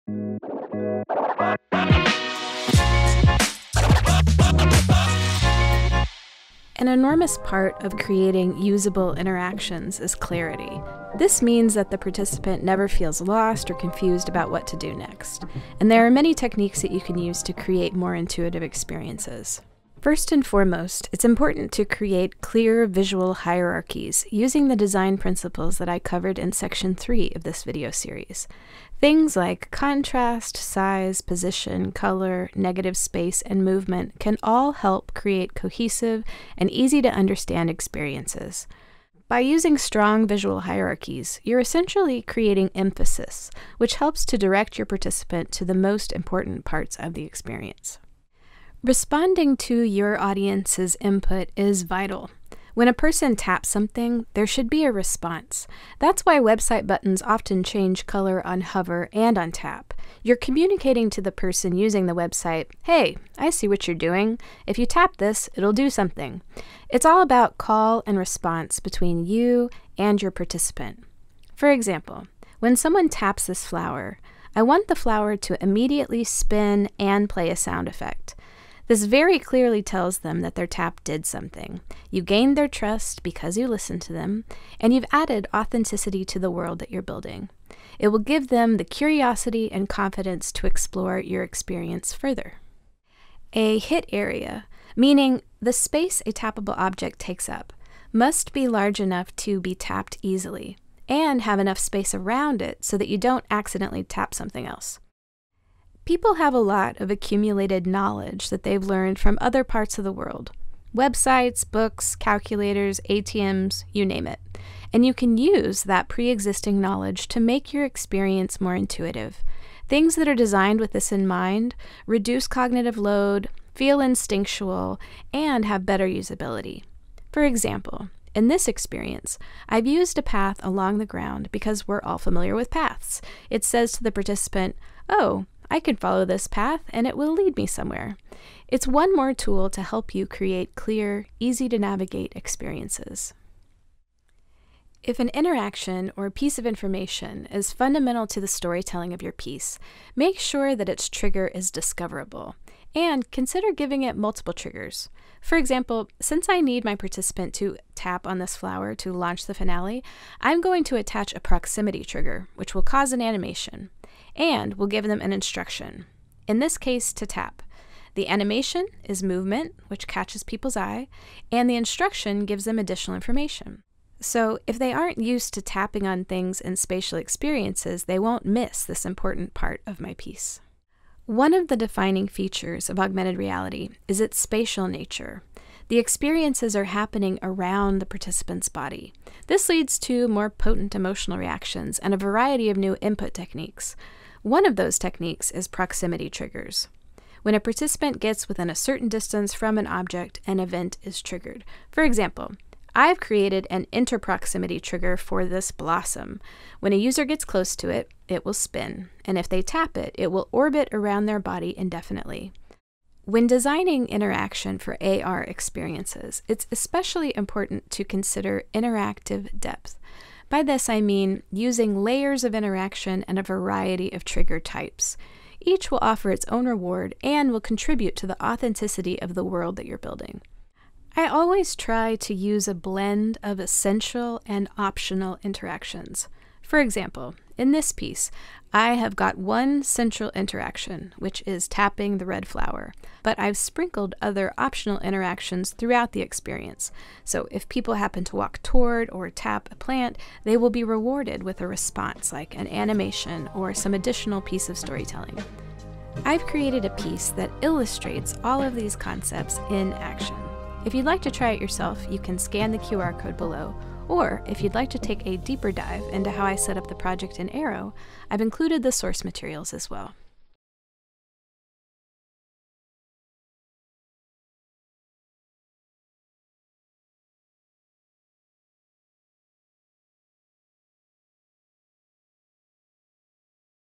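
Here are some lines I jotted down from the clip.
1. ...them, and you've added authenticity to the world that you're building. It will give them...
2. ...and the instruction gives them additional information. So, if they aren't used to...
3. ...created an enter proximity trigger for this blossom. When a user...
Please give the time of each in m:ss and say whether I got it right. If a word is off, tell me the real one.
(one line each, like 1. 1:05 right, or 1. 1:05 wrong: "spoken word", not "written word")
1. 1:24 right
2. 2:51 right
3. 3:23 right.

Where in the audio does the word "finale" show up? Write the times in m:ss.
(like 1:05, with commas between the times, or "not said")
2:39.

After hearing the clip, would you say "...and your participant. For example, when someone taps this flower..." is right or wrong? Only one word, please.
right.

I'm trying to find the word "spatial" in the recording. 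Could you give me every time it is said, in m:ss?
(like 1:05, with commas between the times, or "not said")
2:56, 3:04.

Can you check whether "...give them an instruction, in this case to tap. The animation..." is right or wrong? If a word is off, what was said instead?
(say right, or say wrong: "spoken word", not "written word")
right.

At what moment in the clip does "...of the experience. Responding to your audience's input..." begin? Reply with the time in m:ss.
0:46.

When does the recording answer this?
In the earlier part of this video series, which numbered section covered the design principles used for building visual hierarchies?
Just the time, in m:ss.
0:26.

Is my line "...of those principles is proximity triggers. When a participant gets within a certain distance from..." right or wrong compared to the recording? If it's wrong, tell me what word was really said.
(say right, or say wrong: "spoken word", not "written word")
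wrong: "techniques", not "principles".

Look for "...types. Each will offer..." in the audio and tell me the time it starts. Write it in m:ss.
3:44.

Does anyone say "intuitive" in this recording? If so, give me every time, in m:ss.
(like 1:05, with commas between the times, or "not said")
0:18, 1:58.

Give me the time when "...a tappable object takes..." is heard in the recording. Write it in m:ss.
1:36.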